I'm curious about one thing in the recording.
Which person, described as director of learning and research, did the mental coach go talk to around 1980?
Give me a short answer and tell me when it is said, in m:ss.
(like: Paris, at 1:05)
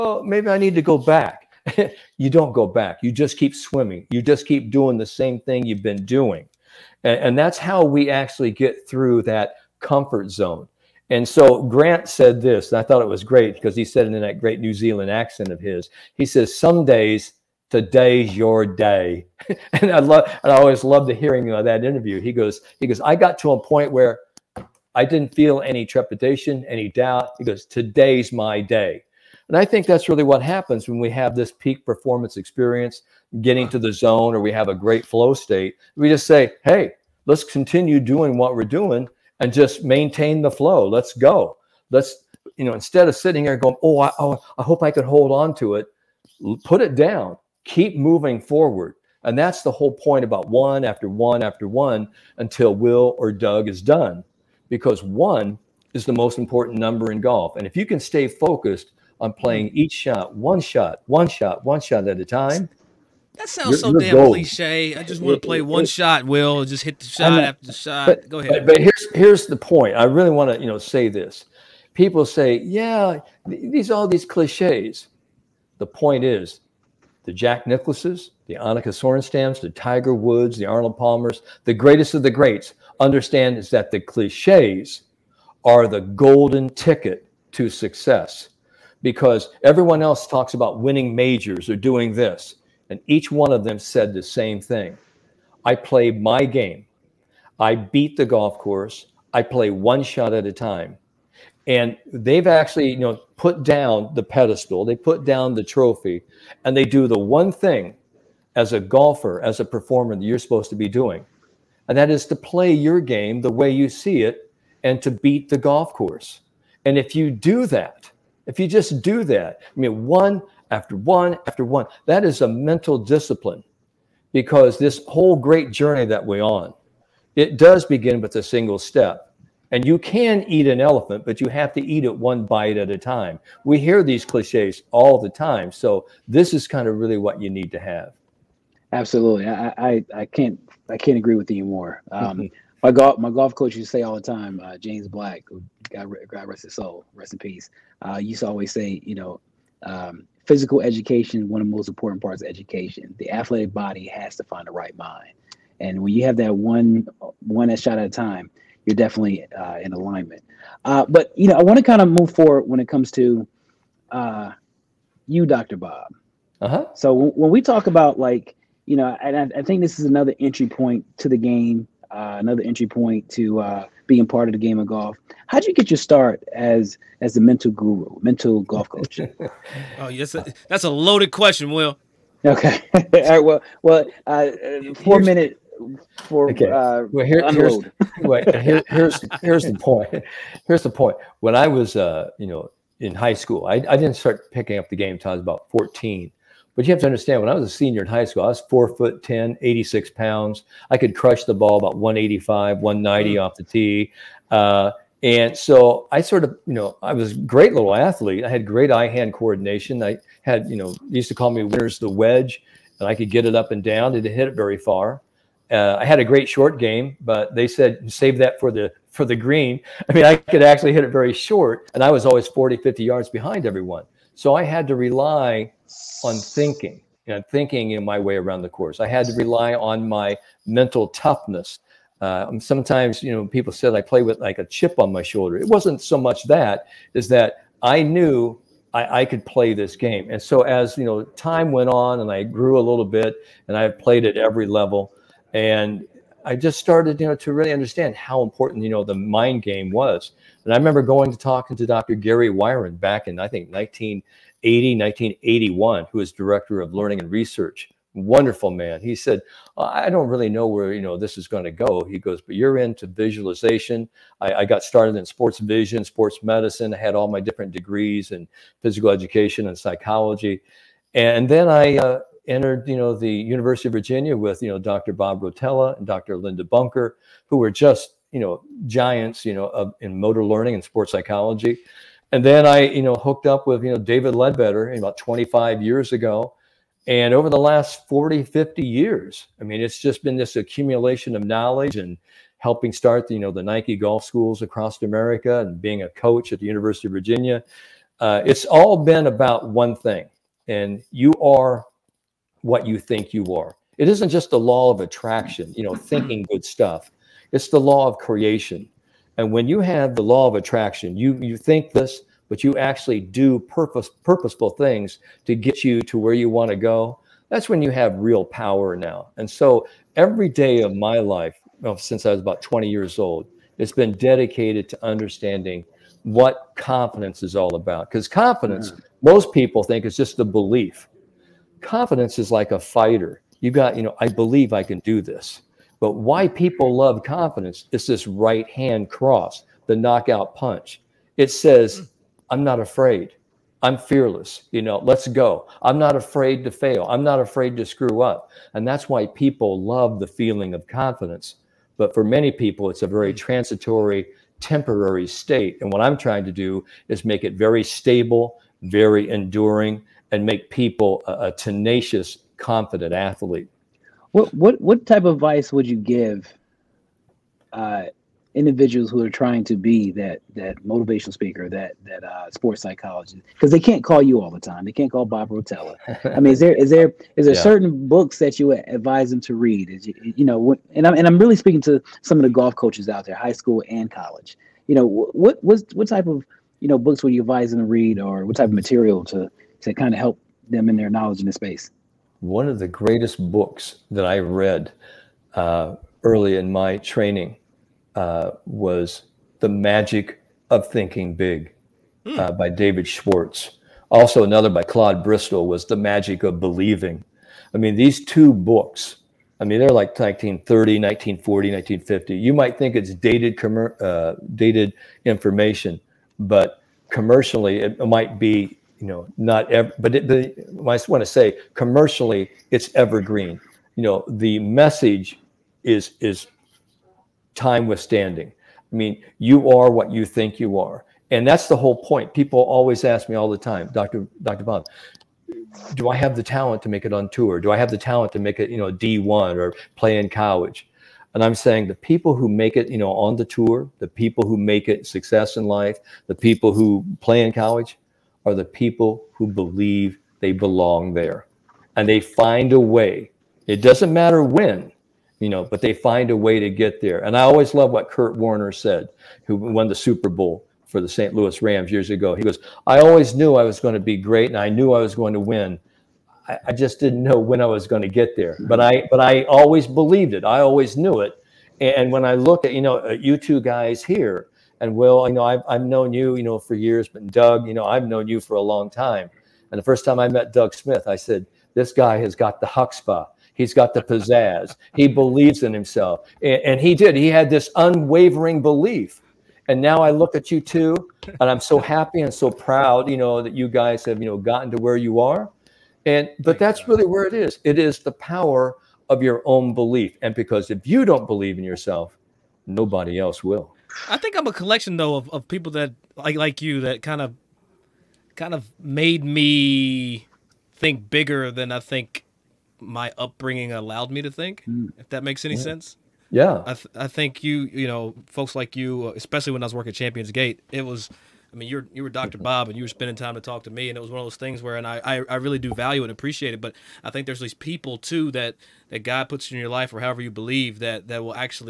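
Dr. Gary Wiren, at 4:11.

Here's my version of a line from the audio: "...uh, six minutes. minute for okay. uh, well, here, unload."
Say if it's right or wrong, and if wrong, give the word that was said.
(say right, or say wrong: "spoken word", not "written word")
wrong: "four", not "six".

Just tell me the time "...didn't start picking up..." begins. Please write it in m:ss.
3:13.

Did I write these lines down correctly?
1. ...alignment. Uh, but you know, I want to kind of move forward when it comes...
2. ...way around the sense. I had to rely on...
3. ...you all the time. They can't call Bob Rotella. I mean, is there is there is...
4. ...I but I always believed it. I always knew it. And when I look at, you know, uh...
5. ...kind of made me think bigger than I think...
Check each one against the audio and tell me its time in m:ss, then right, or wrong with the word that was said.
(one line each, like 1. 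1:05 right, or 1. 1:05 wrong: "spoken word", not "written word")
1. 2:39 right
2. 3:48 wrong: "course", not "sense"
3. 6:14 right
4. 7:48 right
5. 8:28 right.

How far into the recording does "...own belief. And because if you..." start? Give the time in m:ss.
8:19.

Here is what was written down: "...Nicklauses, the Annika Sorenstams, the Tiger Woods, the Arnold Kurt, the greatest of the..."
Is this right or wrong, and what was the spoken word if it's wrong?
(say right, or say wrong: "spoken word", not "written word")
wrong: "Palmers", not "Kurt".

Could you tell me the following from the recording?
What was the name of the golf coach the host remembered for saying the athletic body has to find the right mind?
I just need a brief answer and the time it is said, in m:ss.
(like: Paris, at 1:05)
James Black, at 2:24.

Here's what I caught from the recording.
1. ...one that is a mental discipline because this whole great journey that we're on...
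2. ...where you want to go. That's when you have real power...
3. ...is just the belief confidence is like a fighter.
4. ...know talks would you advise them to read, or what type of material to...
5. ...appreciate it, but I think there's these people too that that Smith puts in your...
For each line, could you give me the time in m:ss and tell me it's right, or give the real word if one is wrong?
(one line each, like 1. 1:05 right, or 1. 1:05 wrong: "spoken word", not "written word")
1. 2:01 right
2. 5:16 right
3. 5:30 right
4. 6:26 wrong: "books", not "talks"
5. 8:46 wrong: "God", not "Smith".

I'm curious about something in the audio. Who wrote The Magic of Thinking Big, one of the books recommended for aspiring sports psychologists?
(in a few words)
David Schwartz.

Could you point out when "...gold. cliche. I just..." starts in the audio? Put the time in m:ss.
1:04.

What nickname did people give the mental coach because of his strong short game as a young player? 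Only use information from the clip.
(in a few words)
Winters the wedge.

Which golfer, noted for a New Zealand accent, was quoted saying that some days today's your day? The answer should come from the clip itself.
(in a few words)
Grant.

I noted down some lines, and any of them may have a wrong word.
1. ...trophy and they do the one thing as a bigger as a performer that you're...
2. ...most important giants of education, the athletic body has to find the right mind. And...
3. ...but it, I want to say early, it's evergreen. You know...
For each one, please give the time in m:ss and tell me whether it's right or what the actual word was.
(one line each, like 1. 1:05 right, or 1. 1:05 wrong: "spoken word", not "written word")
1. 1:45 wrong: "golfer", not "bigger"
2. 2:31 wrong: "parts", not "giants"
3. 6:59 wrong: "commercially", not "early".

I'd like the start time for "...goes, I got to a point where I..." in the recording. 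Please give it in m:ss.
0:22.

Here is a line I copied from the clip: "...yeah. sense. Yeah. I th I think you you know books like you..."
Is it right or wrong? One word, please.
wrong.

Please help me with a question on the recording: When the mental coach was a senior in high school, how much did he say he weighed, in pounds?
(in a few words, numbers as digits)
86.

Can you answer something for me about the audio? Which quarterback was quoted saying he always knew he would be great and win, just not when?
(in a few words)
Kurt Warner.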